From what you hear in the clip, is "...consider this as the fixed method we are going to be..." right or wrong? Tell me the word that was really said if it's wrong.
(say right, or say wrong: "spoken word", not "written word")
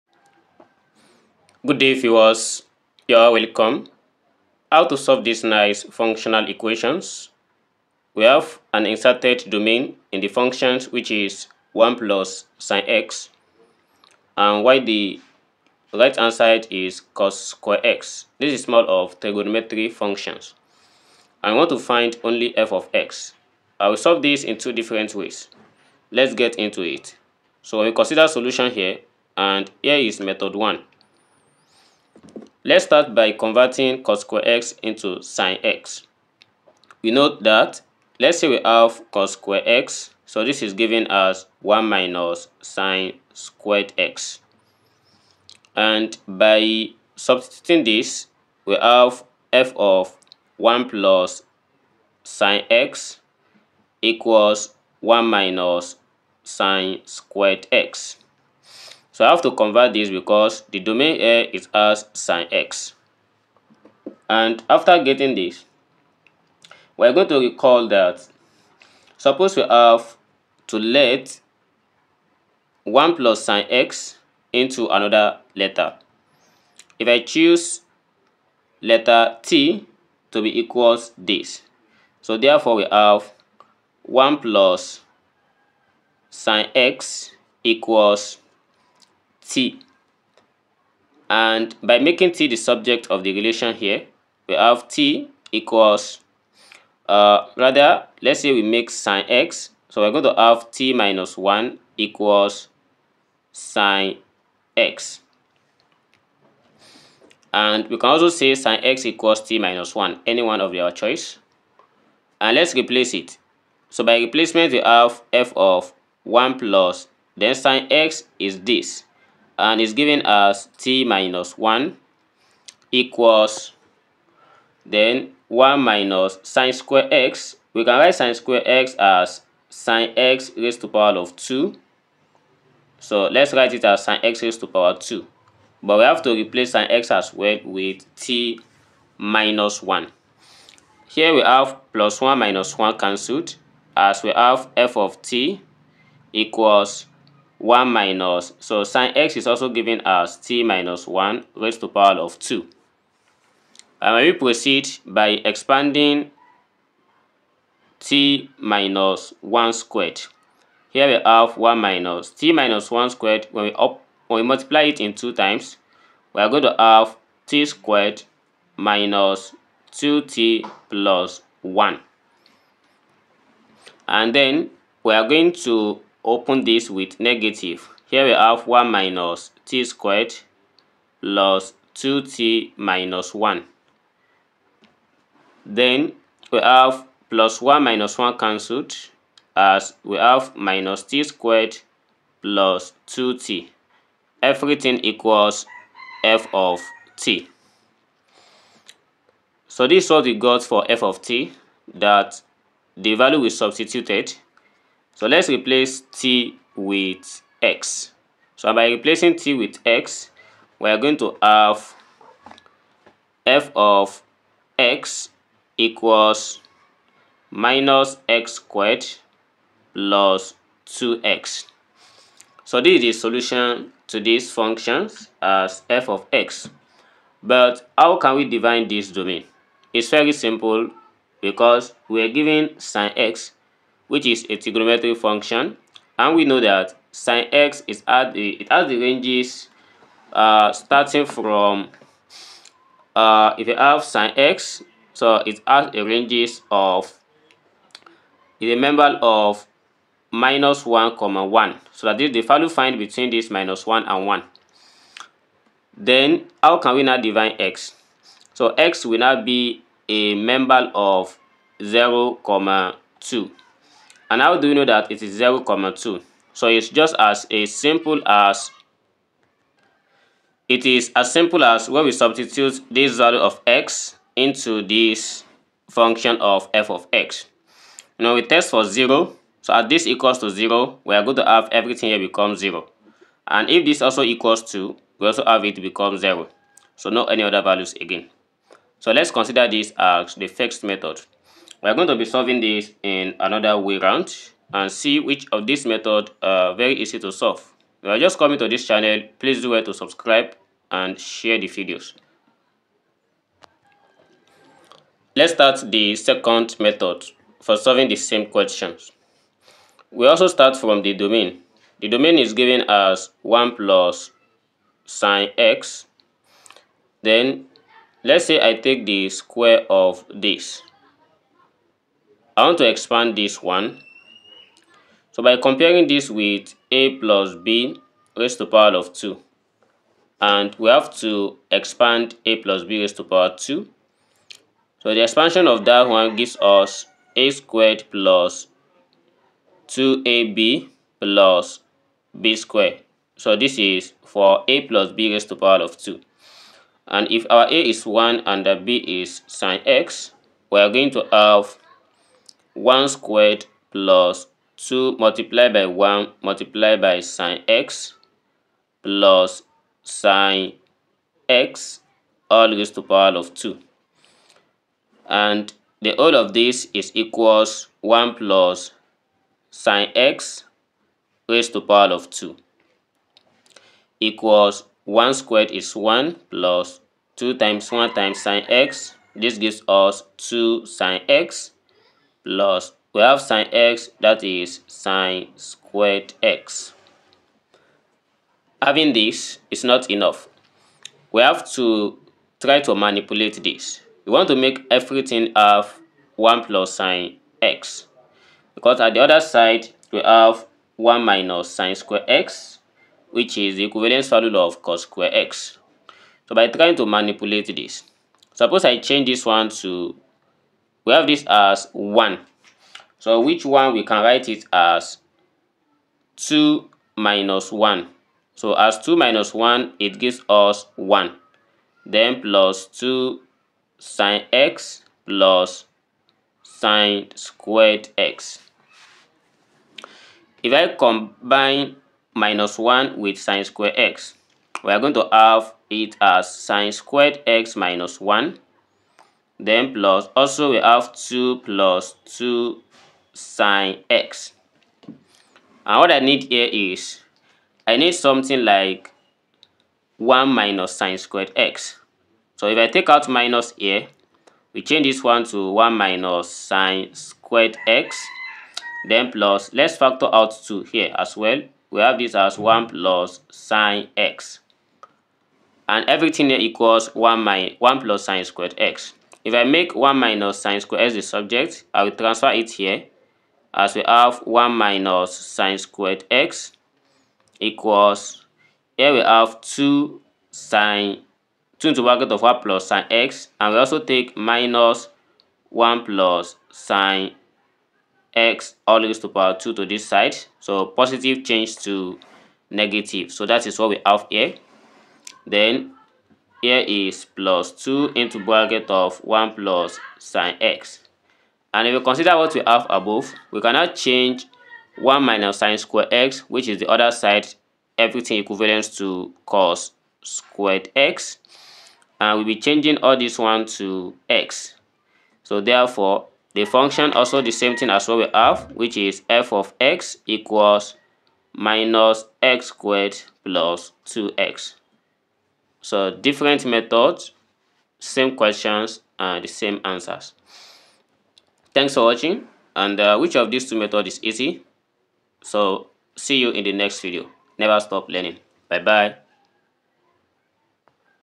right.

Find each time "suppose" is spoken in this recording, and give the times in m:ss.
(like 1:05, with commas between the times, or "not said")
1:09, 6:48.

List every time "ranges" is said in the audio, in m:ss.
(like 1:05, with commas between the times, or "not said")
3:58, 4:06.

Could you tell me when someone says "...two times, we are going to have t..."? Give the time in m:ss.
2:45.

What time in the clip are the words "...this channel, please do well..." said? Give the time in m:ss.
4:58.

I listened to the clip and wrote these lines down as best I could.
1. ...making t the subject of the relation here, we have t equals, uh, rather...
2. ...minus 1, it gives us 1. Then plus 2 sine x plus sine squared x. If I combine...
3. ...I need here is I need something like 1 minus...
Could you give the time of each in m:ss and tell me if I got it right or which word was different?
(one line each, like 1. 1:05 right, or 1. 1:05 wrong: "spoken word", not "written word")
1. 1:31 right
2. 6:59 right
3. 7:26 right.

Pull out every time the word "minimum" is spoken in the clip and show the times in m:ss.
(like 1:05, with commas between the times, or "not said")
not said.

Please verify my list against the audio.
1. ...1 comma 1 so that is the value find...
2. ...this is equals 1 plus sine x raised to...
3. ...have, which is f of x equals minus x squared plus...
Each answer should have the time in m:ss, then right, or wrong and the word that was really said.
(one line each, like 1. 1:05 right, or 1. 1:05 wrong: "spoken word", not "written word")
1. 4:10 right
2. 6:06 right
3. 8:38 right.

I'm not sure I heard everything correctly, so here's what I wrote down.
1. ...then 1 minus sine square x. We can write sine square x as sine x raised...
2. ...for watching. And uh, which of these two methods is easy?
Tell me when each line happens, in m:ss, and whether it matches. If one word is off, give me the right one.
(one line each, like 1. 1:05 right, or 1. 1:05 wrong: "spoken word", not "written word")
1. 2:04 right
2. 8:51 right.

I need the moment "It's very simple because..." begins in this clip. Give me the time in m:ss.
3:49.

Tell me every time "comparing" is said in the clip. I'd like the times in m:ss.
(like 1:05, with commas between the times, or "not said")
5:25.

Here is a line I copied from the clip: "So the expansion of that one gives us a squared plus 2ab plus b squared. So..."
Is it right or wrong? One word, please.
right.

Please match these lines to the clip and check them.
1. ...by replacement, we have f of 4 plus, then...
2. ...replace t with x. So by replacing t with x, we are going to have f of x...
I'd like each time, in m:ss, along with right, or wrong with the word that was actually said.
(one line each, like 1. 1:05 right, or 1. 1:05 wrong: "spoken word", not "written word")
1. 1:54 wrong: "1", not "4"
2. 3:25 right.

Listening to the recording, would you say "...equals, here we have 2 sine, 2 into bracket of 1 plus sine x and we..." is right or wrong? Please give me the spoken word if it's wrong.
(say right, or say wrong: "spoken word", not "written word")
right.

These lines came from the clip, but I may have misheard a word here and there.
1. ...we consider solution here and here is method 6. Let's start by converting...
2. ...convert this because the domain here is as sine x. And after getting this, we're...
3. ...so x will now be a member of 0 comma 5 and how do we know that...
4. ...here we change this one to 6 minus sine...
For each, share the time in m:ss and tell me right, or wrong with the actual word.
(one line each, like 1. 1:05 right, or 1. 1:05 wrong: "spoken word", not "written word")
1. 0:27 wrong: "1", not "6"
2. 0:59 right
3. 4:18 wrong: "2", not "5"
4. 7:33 wrong: "1", not "6".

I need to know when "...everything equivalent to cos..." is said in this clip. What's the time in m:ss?
8:27.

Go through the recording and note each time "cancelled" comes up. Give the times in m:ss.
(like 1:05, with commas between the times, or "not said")
2:22, 3:08.